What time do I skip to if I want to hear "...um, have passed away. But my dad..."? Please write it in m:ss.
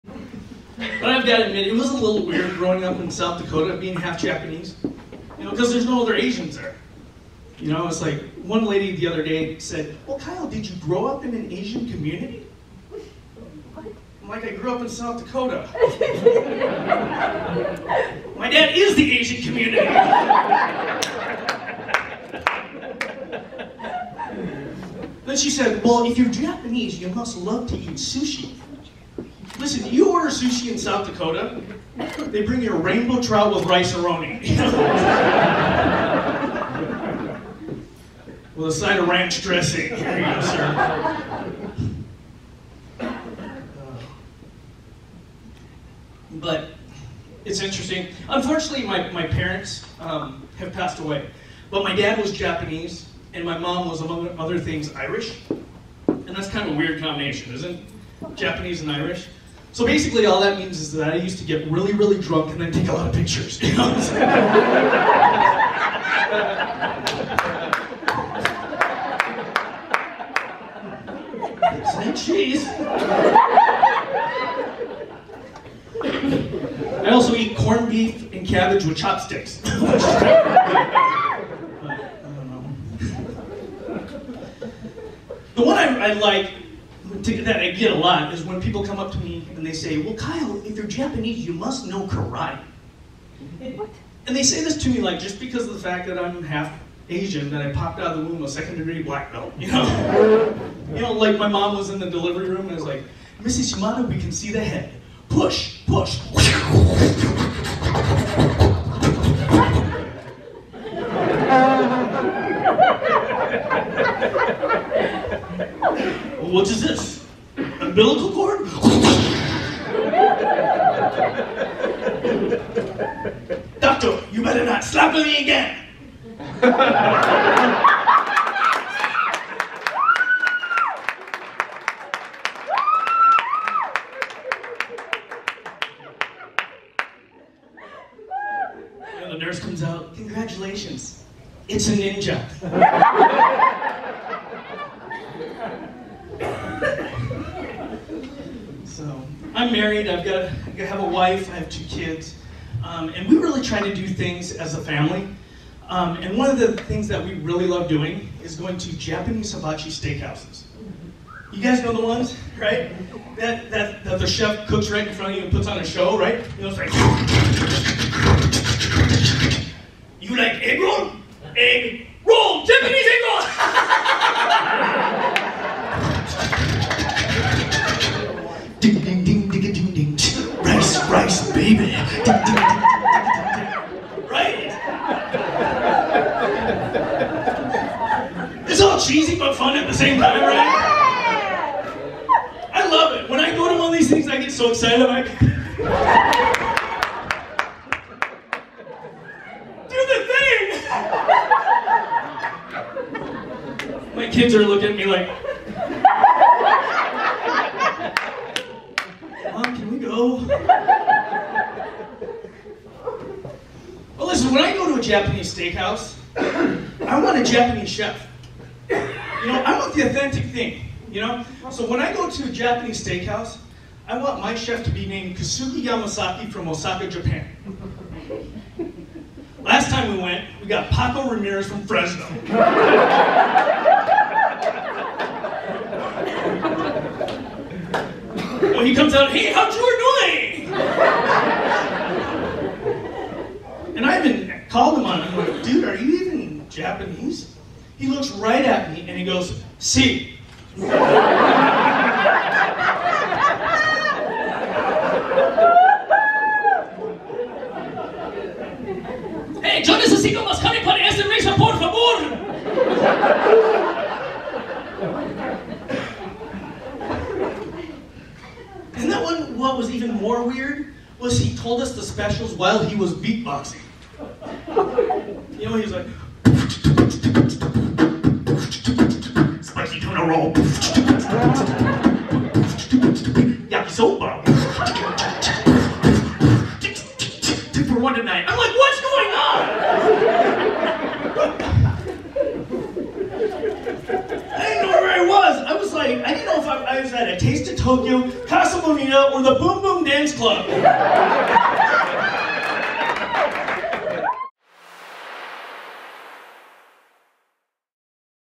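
0:49.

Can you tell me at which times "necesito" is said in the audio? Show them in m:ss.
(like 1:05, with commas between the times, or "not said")
4:19.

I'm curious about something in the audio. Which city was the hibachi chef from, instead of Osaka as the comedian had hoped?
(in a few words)
Fresno.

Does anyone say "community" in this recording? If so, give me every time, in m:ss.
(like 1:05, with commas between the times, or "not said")
0:11, 0:19.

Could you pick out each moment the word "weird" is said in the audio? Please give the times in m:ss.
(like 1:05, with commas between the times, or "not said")
0:02, 0:56, 4:30.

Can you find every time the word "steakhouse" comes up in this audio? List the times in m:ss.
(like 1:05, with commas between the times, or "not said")
2:39, 3:35, 3:43.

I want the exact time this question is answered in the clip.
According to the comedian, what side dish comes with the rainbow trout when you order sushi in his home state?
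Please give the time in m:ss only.
0:33.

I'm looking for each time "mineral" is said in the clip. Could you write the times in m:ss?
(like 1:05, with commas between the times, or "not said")
not said.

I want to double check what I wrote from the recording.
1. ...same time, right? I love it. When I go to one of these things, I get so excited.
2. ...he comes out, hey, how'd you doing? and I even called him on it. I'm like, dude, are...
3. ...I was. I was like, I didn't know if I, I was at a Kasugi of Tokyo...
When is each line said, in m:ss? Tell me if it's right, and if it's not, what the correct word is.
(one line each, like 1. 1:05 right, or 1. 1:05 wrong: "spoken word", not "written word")
1. 3:09 right
2. 3:58 right
3. 4:55 wrong: "Taste", not "Kasugi".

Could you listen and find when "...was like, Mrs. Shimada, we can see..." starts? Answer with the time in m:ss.
1:42.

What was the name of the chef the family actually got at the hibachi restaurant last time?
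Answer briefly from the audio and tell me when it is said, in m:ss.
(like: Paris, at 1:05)
Paco Ramirez, at 3:50.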